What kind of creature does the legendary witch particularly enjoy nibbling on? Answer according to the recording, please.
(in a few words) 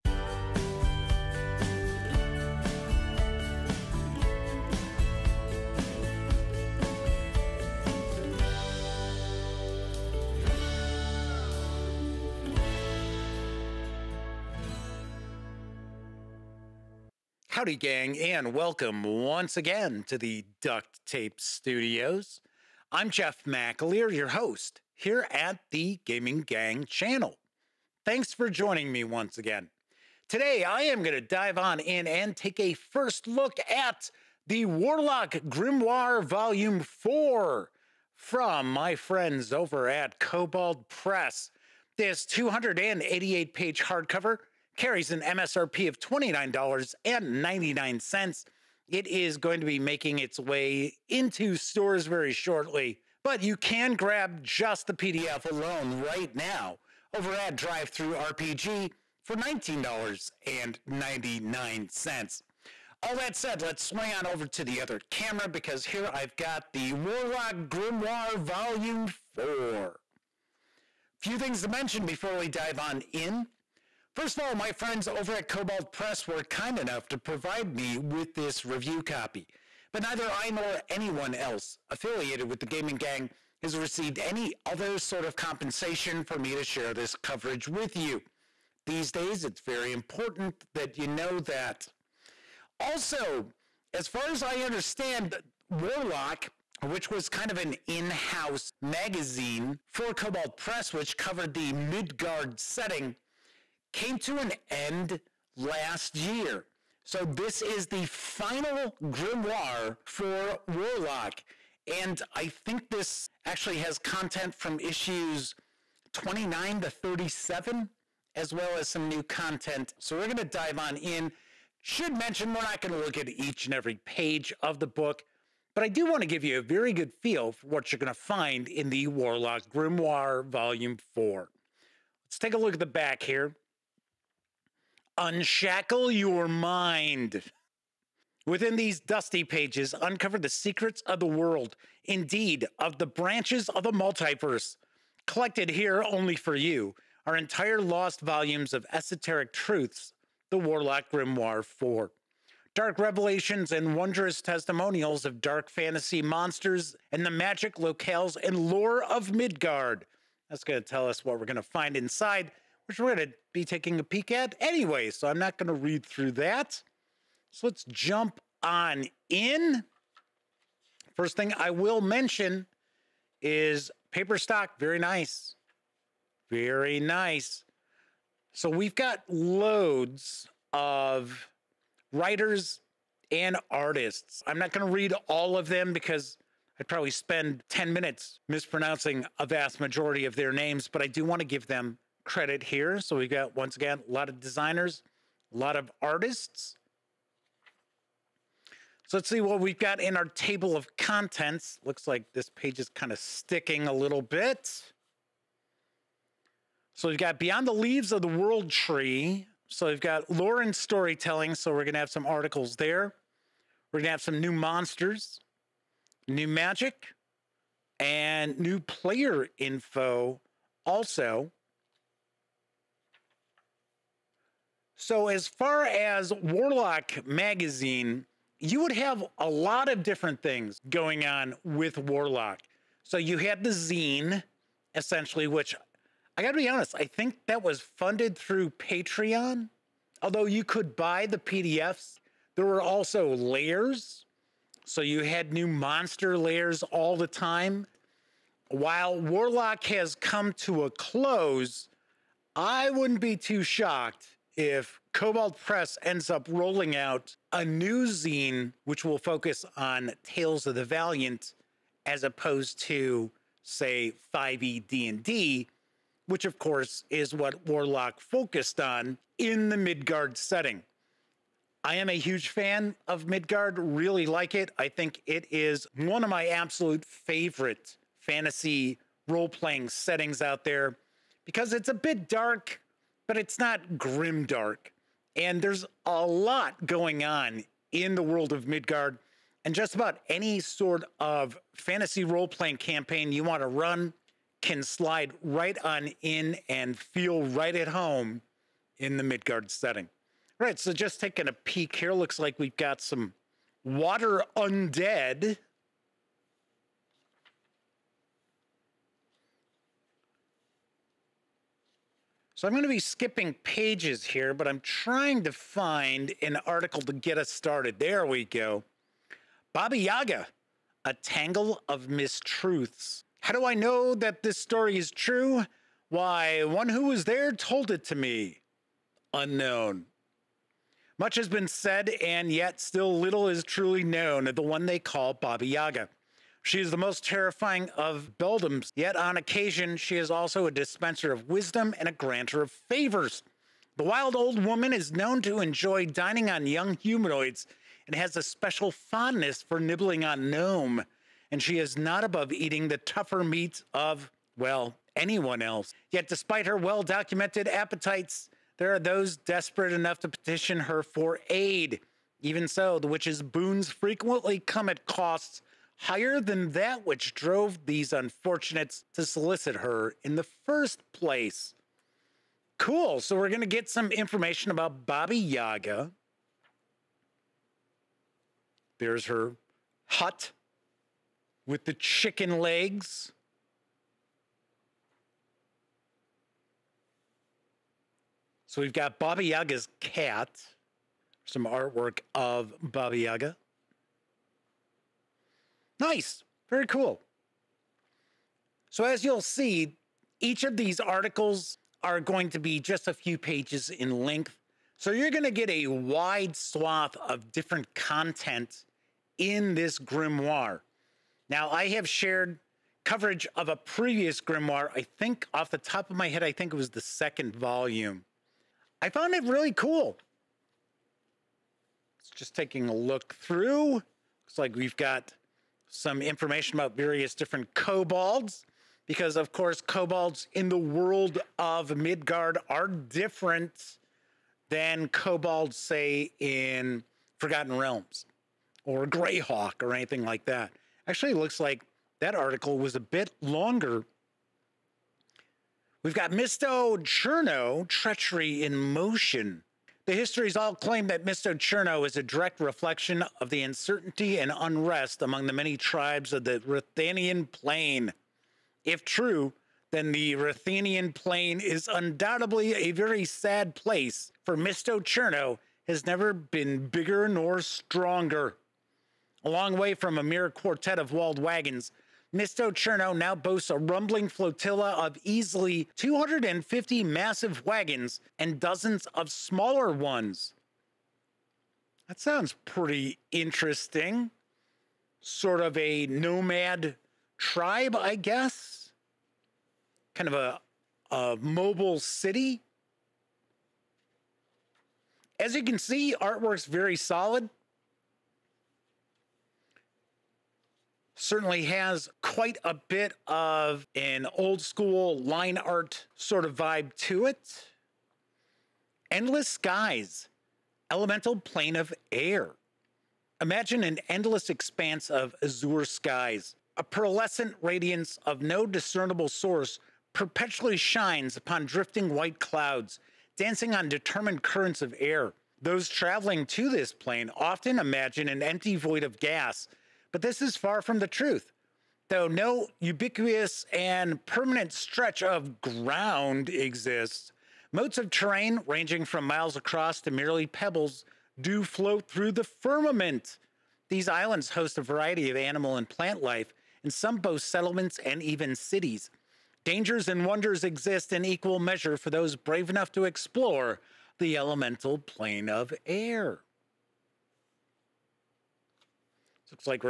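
gnome.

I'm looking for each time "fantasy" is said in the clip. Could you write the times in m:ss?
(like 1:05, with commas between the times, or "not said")
2:35, 4:38, 4:51.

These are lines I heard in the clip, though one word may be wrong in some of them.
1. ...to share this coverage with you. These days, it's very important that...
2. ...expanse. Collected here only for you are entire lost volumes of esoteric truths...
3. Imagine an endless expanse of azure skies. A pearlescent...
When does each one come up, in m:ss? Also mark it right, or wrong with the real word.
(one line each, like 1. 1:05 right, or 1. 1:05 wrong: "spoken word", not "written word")
1. 1:26 right
2. 2:23 wrong: "multiverse", not "expanse"
3. 8:33 right.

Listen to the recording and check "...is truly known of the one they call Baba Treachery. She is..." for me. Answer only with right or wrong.
wrong.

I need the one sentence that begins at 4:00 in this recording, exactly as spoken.
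Although you could buy the PDFs, there were also lairs.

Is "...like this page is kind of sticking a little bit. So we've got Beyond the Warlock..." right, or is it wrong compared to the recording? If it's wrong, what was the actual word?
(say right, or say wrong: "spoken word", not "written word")
wrong: "Leaves", not "Warlock".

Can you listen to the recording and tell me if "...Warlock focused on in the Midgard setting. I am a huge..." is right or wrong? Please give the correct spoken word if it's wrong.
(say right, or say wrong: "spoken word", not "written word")
right.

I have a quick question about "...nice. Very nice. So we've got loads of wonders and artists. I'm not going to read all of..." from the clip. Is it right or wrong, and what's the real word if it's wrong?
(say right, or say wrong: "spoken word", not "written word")
wrong: "writers", not "wonders".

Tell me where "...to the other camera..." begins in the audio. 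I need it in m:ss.
1:04.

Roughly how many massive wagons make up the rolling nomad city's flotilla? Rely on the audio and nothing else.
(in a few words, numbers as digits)
250.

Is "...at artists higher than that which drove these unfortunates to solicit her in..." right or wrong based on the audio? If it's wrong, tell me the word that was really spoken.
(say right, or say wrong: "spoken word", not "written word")
wrong: "costs", not "artists".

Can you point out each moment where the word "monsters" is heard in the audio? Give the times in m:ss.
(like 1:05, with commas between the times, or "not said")
2:36, 3:34, 4:05.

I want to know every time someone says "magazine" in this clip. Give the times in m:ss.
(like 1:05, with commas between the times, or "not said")
1:38, 3:47.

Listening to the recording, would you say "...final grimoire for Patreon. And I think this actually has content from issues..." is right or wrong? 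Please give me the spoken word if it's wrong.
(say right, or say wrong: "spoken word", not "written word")
wrong: "Warlock", not "Patreon".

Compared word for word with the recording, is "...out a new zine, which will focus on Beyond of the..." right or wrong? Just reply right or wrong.
wrong.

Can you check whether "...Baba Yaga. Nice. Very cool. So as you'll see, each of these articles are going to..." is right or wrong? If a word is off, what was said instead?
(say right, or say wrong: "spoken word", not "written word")
right.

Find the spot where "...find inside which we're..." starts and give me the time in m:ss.
2:41.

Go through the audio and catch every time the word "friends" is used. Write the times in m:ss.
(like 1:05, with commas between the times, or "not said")
0:38, 1:14.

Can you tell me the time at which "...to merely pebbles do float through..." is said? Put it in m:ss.
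9:00.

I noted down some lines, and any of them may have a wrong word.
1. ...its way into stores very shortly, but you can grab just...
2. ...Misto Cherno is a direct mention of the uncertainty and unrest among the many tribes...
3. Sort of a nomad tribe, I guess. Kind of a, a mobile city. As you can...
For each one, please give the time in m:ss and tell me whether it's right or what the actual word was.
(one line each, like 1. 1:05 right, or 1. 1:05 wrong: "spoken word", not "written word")
1. 0:50 right
2. 7:31 wrong: "reflection", not "mention"
3. 8:05 right.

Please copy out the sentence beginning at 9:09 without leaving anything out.
Dangers and wonders exist in equal measure for those brave enough to explore the elemental plane of air.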